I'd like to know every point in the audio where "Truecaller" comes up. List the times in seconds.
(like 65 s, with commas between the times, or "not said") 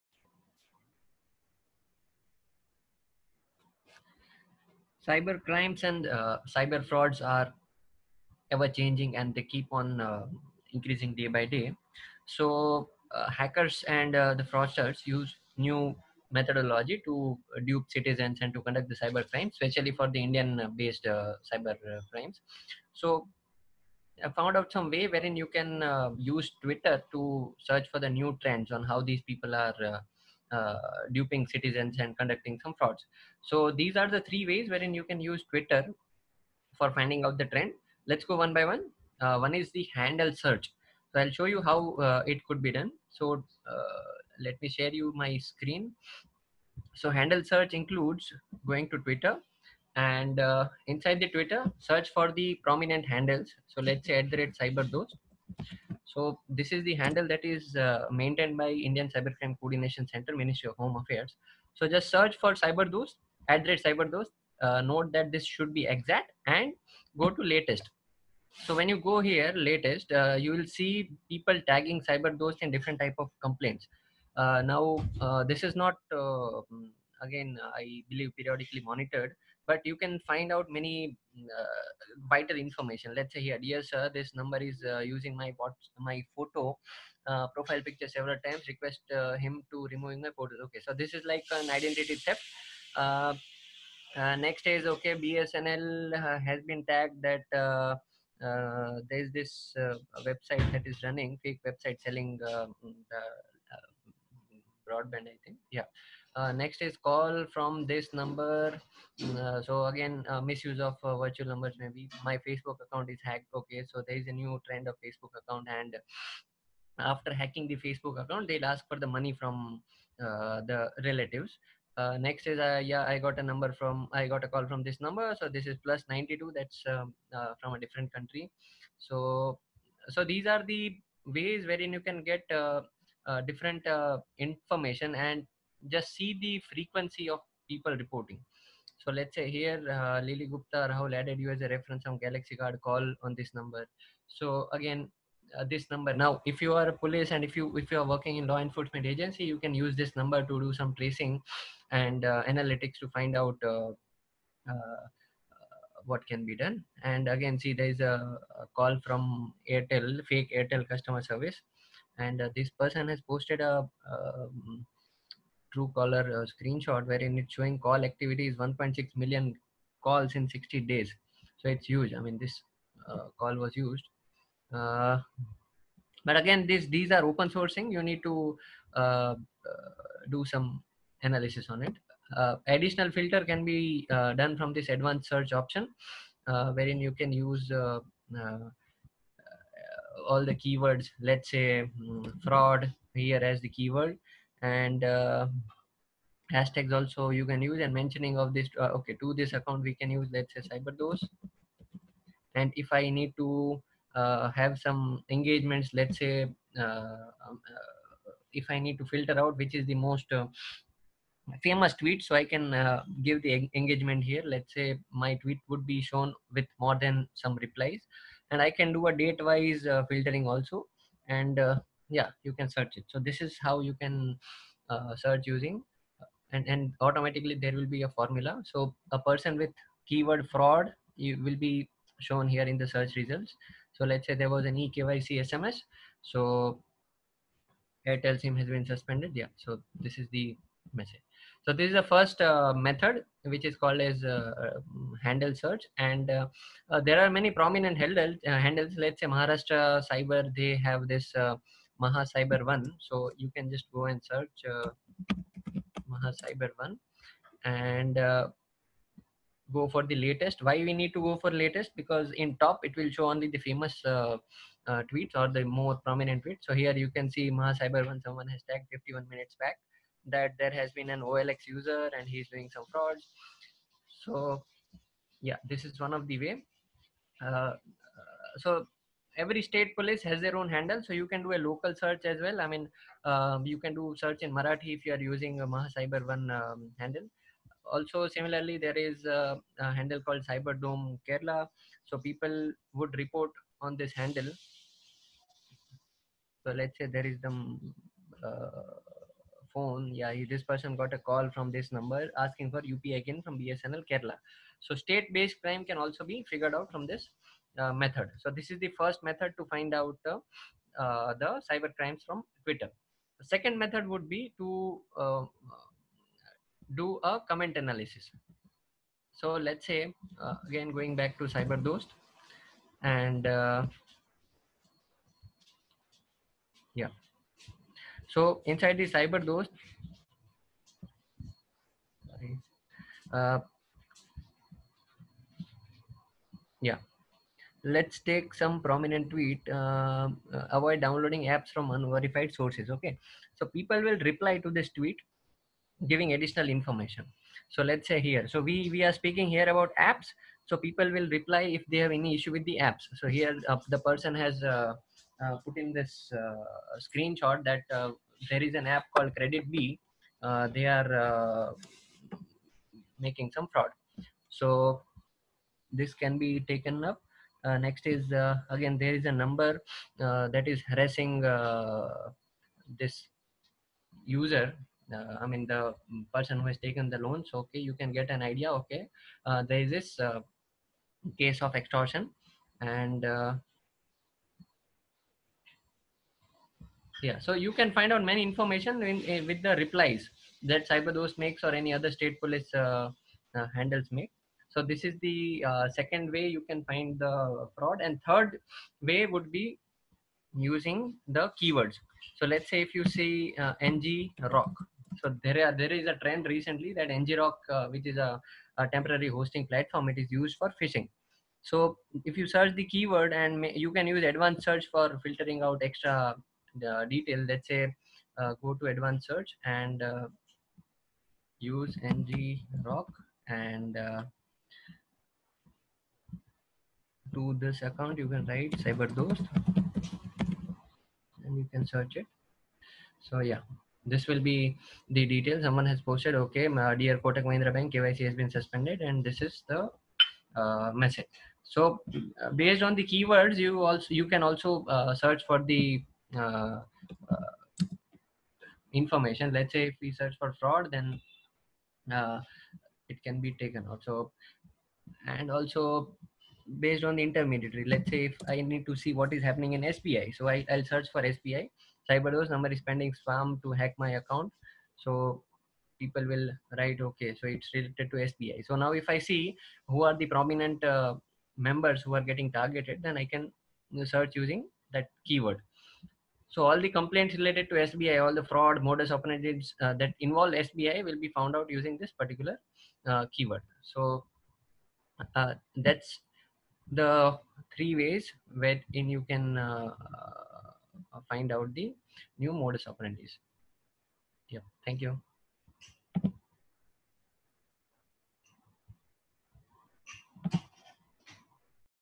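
165 s.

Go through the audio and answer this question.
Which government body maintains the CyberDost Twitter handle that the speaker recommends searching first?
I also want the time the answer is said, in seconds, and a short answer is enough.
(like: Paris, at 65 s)
Indian Cybercrime Coordination Center, at 58 s.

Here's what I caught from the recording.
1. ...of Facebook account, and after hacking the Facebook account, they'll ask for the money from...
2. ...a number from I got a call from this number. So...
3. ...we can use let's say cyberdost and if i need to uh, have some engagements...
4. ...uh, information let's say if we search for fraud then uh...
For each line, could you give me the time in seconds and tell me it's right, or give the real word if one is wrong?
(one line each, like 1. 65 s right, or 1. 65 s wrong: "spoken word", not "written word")
1. 114 s right
2. 123 s right
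3. 199 s right
4. 447 s right.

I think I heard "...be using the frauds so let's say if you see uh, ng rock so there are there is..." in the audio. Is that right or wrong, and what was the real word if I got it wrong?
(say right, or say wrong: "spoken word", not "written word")
wrong: "keywords", not "frauds".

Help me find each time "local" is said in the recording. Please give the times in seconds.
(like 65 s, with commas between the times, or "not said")
281 s.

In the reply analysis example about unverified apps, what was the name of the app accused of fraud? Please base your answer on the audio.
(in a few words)
Credit B.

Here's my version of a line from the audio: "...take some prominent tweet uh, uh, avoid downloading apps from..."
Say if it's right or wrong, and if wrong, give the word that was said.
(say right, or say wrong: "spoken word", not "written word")
right.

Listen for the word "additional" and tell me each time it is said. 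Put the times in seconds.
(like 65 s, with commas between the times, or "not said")
182 s, 346 s.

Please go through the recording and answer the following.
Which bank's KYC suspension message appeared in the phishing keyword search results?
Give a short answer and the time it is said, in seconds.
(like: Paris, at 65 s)
Kotak Mahindra Bank, at 437 s.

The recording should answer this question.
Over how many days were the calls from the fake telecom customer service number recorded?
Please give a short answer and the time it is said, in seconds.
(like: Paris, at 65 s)
60 days, at 170 s.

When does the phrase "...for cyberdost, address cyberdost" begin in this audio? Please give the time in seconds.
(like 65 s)
62 s.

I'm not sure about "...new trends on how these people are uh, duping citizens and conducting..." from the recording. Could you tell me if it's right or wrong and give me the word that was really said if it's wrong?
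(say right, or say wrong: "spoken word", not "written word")
right.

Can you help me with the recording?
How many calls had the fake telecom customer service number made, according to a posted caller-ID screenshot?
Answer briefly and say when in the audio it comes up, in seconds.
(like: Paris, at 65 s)
1.6 million, at 168 s.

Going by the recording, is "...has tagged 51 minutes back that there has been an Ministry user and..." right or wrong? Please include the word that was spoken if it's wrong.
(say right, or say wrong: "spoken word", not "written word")
wrong: "OLX", not "Ministry".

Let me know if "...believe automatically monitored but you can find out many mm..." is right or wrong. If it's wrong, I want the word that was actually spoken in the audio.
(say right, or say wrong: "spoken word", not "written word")
wrong: "periodically", not "automatically".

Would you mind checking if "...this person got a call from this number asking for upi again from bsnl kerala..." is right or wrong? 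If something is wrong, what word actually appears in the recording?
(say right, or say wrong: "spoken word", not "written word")
right.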